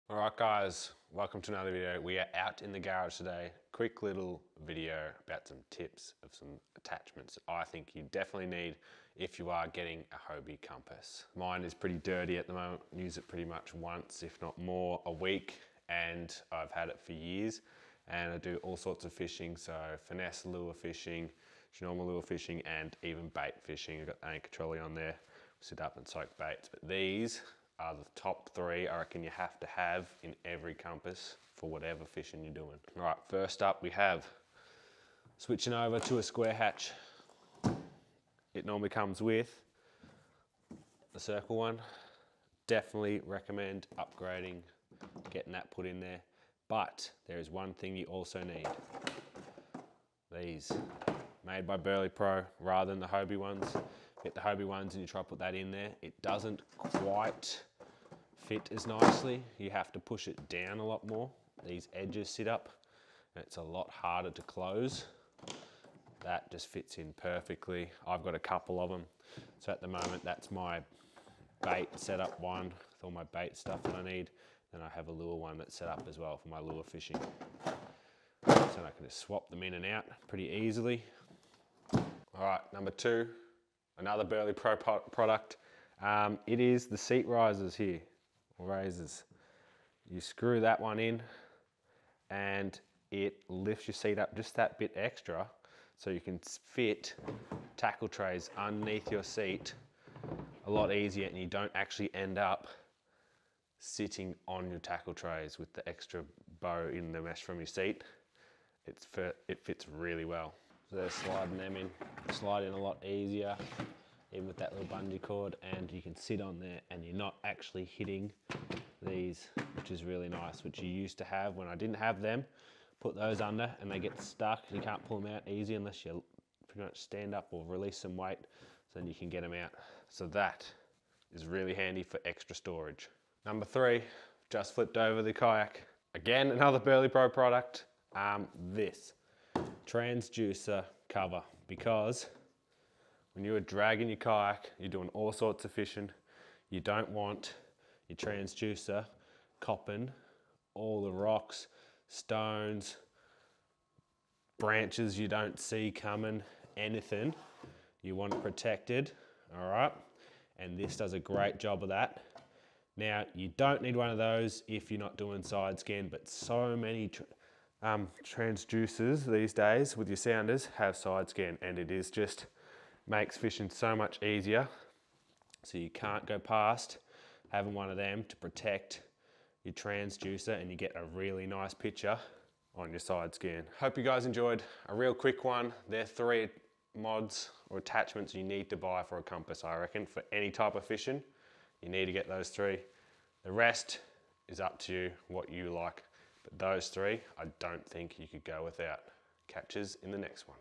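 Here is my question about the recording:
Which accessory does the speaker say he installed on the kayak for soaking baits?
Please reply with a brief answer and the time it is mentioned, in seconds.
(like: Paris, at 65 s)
Anchor trolley, at 24 s.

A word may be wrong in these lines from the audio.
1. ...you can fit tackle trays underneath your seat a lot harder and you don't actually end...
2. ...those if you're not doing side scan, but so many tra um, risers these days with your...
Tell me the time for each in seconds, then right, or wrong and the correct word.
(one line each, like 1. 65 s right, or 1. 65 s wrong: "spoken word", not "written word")
1. 96 s wrong: "easier", not "harder"
2. 164 s wrong: "transducers", not "risers".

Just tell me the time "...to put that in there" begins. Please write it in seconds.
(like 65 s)
55 s.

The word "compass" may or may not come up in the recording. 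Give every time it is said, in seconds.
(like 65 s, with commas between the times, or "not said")
10 s, 30 s, 189 s.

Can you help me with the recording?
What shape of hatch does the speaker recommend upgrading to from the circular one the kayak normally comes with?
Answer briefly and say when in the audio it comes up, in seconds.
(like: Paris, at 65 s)
Square, at 36 s.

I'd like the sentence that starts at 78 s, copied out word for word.
So I can just swap them in and out pretty easily.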